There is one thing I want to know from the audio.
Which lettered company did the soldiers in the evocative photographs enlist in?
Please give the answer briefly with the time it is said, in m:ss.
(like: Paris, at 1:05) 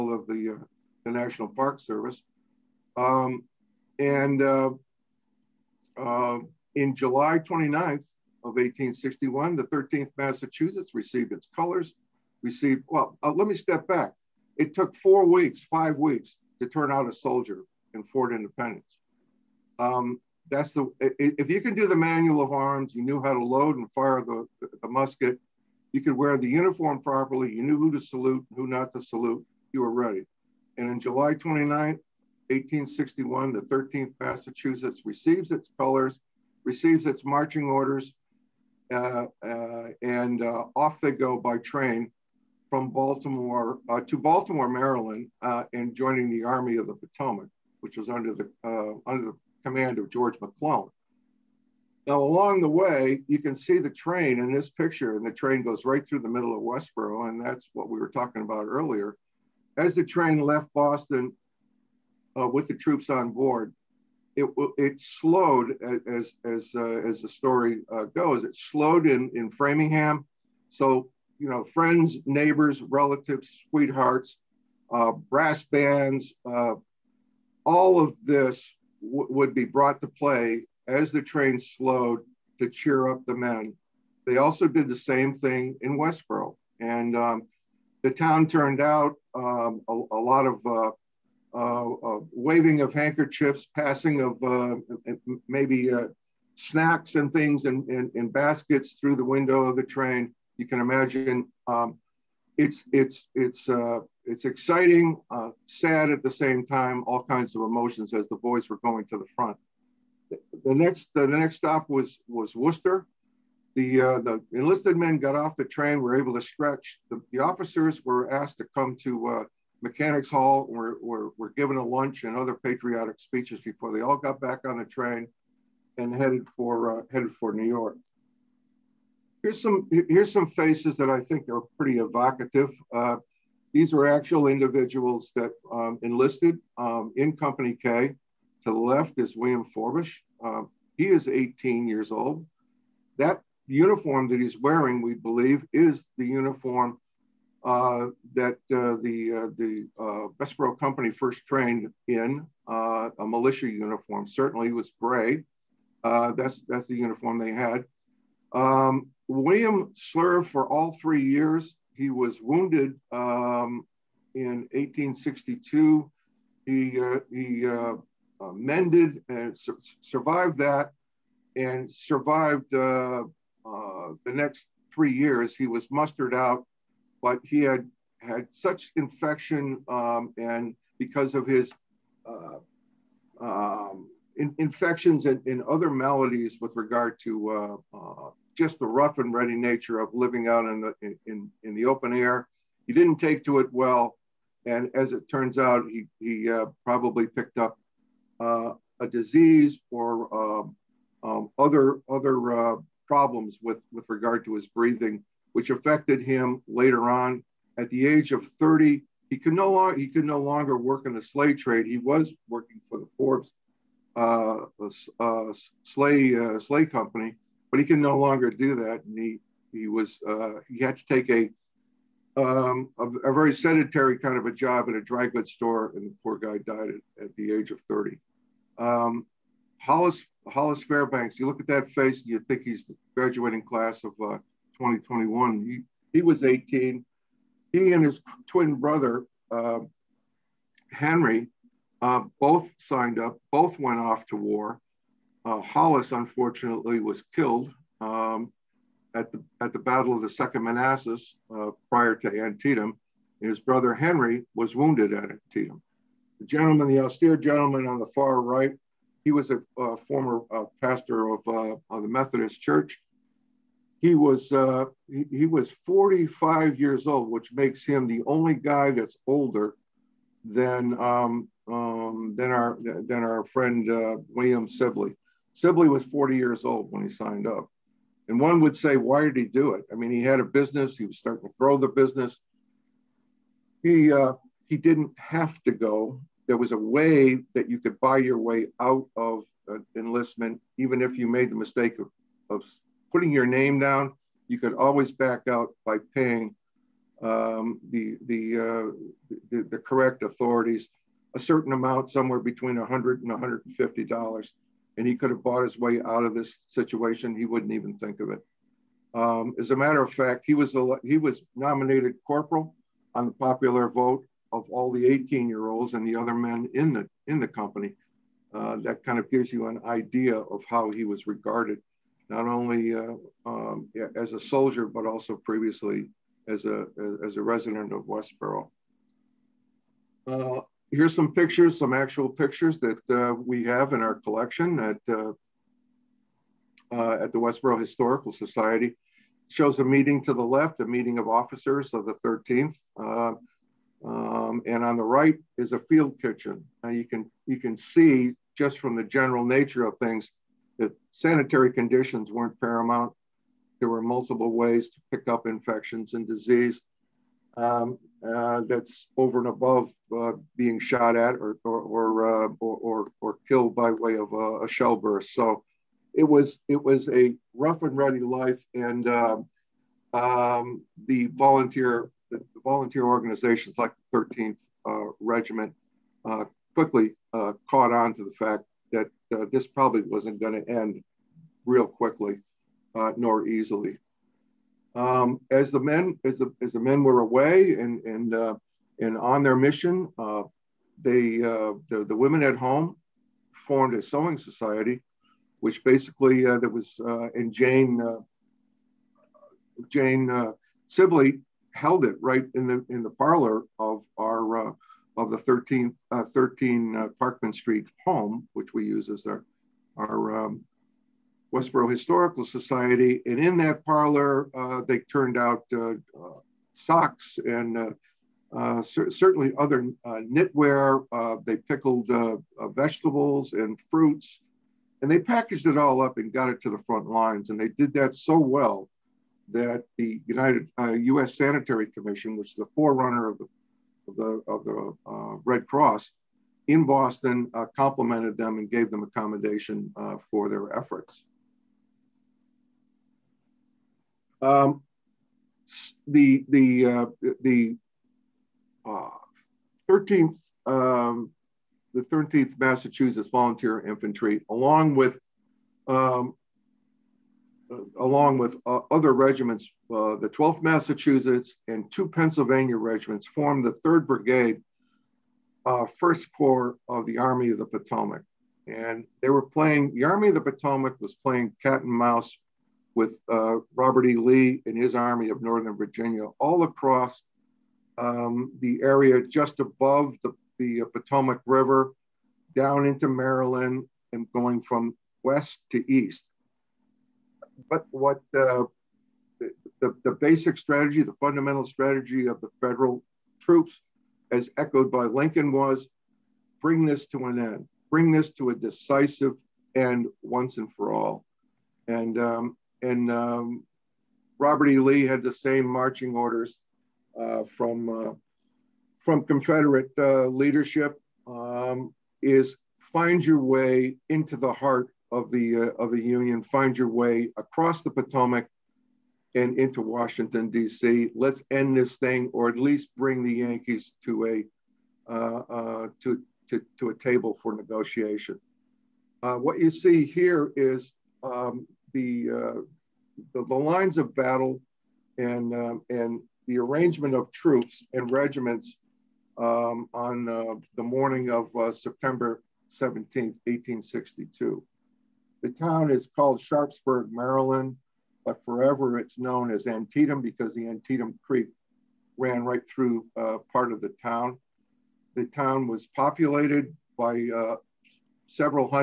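Company K, at 2:17.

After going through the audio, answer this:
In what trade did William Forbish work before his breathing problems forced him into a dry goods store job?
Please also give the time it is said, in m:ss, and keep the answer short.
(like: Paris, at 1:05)
sleigh trade, at 3:31.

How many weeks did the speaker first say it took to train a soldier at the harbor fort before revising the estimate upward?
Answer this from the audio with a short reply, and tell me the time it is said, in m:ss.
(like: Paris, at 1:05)
4, at 0:14.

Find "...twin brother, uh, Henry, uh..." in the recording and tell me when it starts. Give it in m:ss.
3:58.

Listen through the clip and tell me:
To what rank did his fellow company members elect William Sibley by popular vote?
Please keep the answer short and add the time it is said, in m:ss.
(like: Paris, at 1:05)
corporal, at 5:12.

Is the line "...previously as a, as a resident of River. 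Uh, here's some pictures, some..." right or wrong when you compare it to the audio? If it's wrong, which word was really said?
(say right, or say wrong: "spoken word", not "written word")
wrong: "Westboro", not "River".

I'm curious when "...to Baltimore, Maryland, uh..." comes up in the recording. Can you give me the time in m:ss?
0:44.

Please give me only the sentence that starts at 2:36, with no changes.
that's, that's the uniform they had.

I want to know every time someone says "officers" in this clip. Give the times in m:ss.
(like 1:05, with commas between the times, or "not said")
1:57, 5:41.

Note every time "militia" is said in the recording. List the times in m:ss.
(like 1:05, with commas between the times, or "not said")
2:33.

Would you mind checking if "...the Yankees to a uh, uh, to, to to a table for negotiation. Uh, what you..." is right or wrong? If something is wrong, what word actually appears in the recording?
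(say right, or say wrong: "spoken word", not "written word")
right.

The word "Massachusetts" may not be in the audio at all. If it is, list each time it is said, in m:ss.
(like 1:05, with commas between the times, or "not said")
0:10, 0:34, 7:32, 7:40.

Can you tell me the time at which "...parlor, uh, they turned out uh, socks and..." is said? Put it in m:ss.
6:53.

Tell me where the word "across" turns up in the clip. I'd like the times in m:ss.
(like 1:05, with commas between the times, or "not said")
7:56, 8:37.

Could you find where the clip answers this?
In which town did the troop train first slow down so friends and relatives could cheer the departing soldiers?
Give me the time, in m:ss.
1:09.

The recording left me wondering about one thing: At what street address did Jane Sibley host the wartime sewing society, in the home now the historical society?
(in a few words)
13 Parkman Street.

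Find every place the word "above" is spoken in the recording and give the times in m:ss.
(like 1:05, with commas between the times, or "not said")
5:59, 7:59.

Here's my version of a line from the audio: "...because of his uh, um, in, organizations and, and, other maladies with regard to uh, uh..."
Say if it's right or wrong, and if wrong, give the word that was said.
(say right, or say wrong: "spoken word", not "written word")
wrong: "infections", not "organizations".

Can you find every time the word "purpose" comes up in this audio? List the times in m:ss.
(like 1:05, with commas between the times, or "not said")
not said.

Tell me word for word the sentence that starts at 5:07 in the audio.
He wouldn't even think of it.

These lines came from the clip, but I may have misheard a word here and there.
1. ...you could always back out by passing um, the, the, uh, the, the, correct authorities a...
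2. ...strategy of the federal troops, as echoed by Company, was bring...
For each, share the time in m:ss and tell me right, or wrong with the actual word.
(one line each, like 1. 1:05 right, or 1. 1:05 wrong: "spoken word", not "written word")
1. 4:54 wrong: "paying", not "passing"
2. 8:11 wrong: "Lincoln", not "Company".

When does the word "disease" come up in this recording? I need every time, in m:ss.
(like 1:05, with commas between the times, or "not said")
3:19, 5:56.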